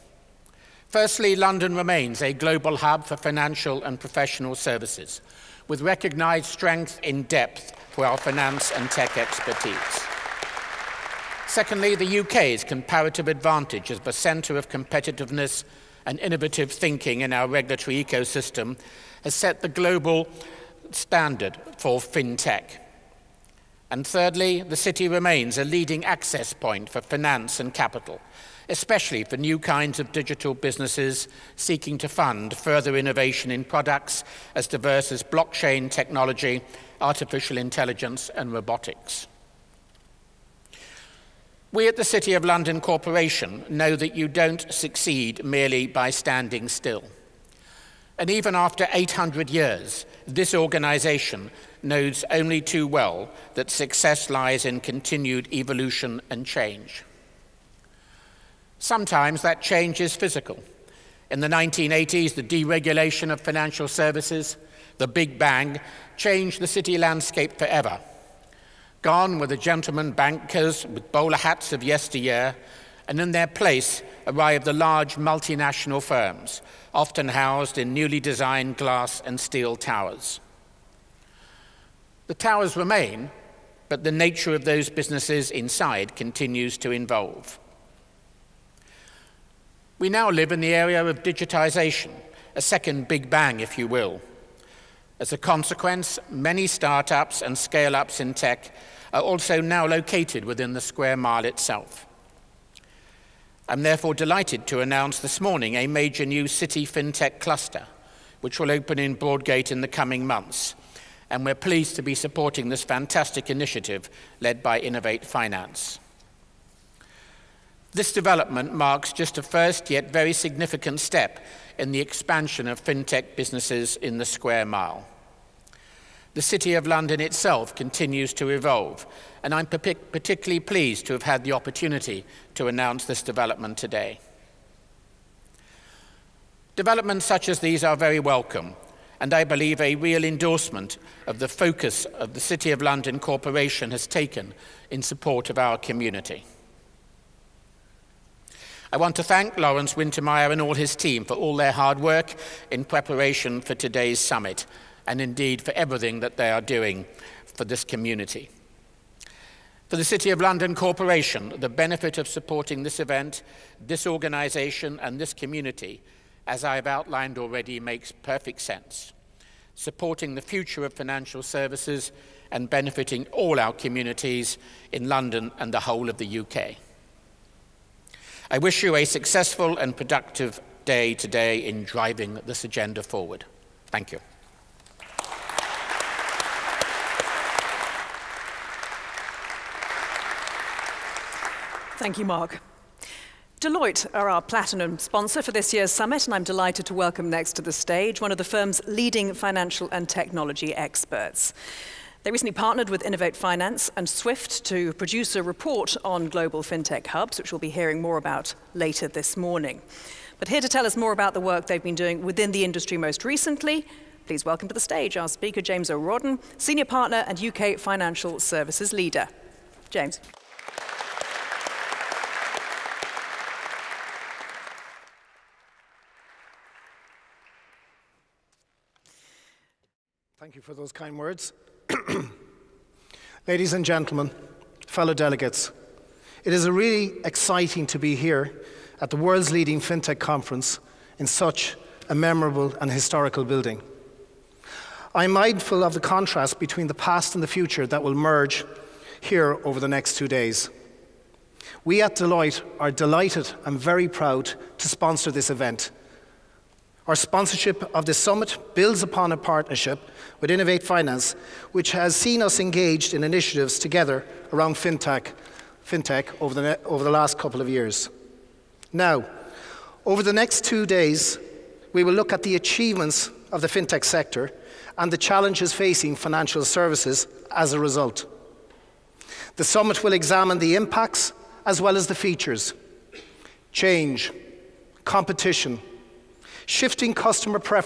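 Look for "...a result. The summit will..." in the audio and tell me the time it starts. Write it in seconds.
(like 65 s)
277 s.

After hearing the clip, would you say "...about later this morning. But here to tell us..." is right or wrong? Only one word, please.
right.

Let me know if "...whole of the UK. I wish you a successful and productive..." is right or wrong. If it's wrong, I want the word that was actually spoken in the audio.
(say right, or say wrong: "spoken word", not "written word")
right.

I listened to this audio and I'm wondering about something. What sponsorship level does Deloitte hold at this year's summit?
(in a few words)
Platinum.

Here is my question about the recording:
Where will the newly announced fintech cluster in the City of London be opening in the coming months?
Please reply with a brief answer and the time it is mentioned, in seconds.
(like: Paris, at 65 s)
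Broadgate, at 109 s.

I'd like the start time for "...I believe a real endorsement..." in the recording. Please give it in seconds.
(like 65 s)
139 s.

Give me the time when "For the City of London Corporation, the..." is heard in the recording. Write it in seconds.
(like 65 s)
159 s.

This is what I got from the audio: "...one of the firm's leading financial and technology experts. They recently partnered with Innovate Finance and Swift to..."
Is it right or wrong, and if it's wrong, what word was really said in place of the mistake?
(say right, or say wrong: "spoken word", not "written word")
right.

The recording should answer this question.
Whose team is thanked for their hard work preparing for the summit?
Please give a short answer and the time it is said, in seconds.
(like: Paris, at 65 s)
Lawrence Wintermeyer, at 149 s.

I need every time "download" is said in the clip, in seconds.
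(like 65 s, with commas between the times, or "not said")
not said.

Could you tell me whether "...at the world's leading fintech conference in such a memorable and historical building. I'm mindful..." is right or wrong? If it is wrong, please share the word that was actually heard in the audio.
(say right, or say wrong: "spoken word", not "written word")
right.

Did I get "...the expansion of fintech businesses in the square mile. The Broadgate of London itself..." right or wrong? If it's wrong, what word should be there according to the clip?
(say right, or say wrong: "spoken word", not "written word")
wrong: "City", not "Broadgate".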